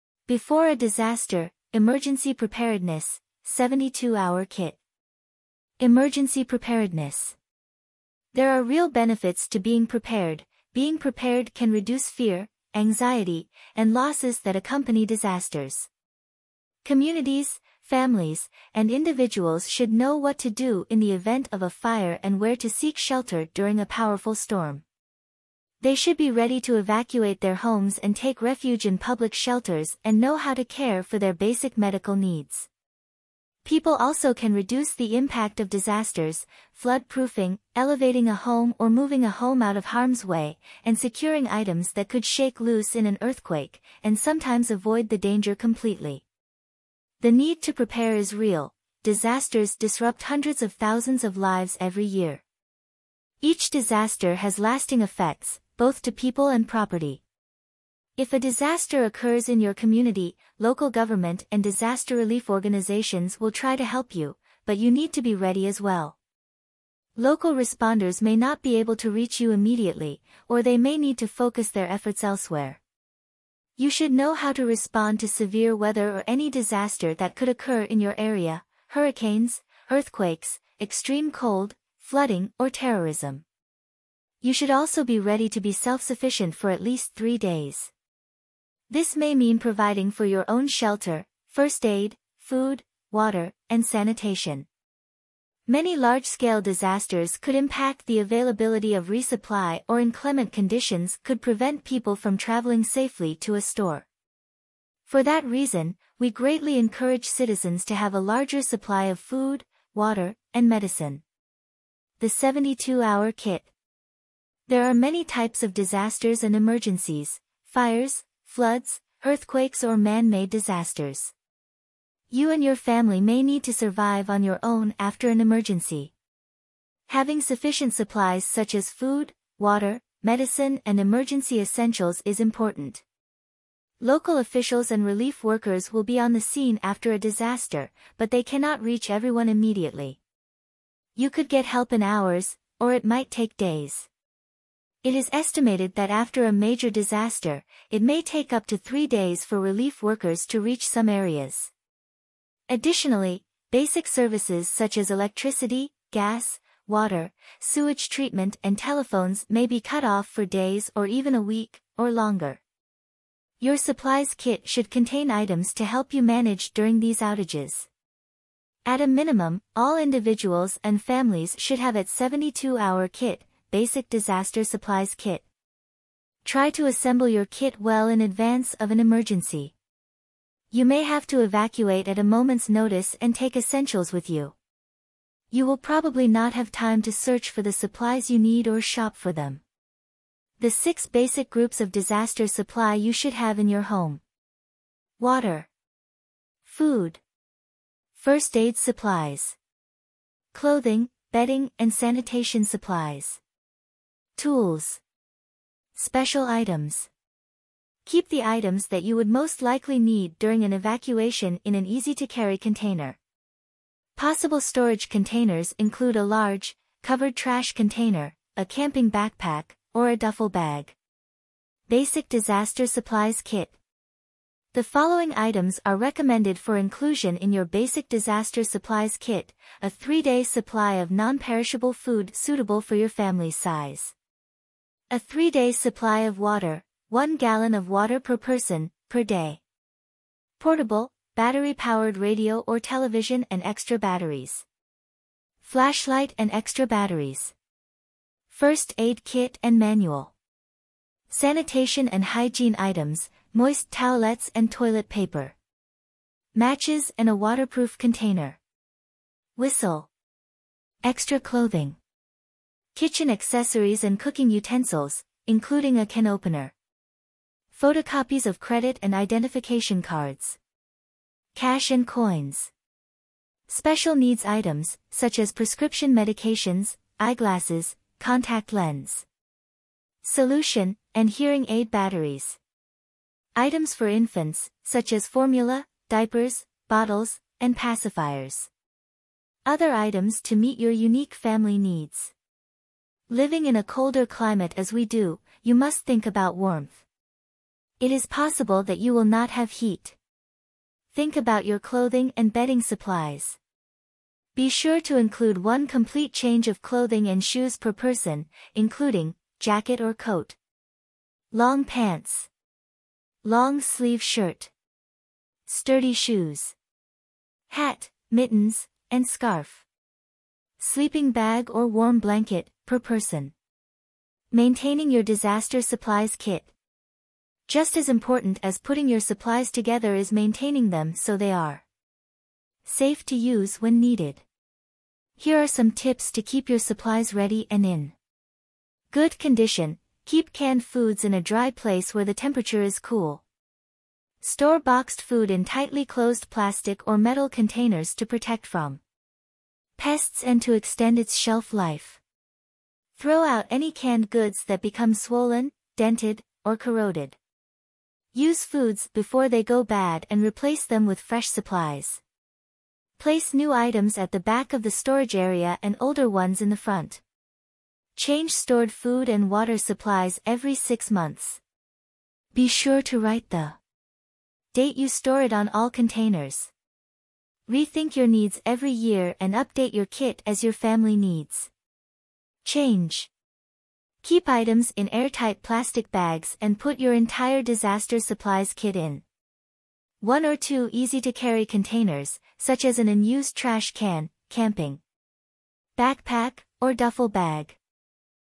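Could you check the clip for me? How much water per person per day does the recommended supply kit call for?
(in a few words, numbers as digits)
1 gallon.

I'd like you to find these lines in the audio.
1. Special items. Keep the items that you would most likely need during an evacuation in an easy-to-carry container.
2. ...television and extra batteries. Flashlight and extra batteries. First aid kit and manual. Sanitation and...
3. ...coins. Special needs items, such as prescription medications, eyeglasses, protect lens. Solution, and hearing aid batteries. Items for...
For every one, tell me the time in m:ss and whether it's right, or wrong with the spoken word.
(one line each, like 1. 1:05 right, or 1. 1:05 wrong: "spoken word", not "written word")
1. 3:25 right
2. 4:02 right
3. 4:32 wrong: "contact", not "protect".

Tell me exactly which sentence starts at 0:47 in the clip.
The need to prepare is real.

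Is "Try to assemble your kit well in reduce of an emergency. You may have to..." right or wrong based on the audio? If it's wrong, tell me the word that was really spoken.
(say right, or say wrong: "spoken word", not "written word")
wrong: "advance", not "reduce".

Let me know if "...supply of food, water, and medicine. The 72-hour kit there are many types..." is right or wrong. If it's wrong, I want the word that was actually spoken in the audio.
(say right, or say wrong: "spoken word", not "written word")
right.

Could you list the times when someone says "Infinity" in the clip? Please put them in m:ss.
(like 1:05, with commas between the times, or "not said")
not said.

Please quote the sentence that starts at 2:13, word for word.
Local officials and relief workers will be on the scene after a disaster, but they cannot reach everyone immediately.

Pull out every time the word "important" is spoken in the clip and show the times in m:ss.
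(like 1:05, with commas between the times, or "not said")
2:12, 5:28.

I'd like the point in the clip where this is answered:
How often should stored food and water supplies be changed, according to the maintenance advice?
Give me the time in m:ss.
6:10.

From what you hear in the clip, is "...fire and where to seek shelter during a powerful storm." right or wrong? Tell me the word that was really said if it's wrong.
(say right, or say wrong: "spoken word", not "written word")
right.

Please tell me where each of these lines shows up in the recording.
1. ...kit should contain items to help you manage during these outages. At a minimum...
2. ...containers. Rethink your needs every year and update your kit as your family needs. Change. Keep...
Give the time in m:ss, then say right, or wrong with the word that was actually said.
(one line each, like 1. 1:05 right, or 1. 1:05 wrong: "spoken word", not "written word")
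1. 2:44 right
2. 6:15 right.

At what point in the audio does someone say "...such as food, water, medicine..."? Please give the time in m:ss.
2:08.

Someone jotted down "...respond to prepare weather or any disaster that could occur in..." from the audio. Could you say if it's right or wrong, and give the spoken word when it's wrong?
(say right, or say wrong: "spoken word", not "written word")
wrong: "severe", not "prepare".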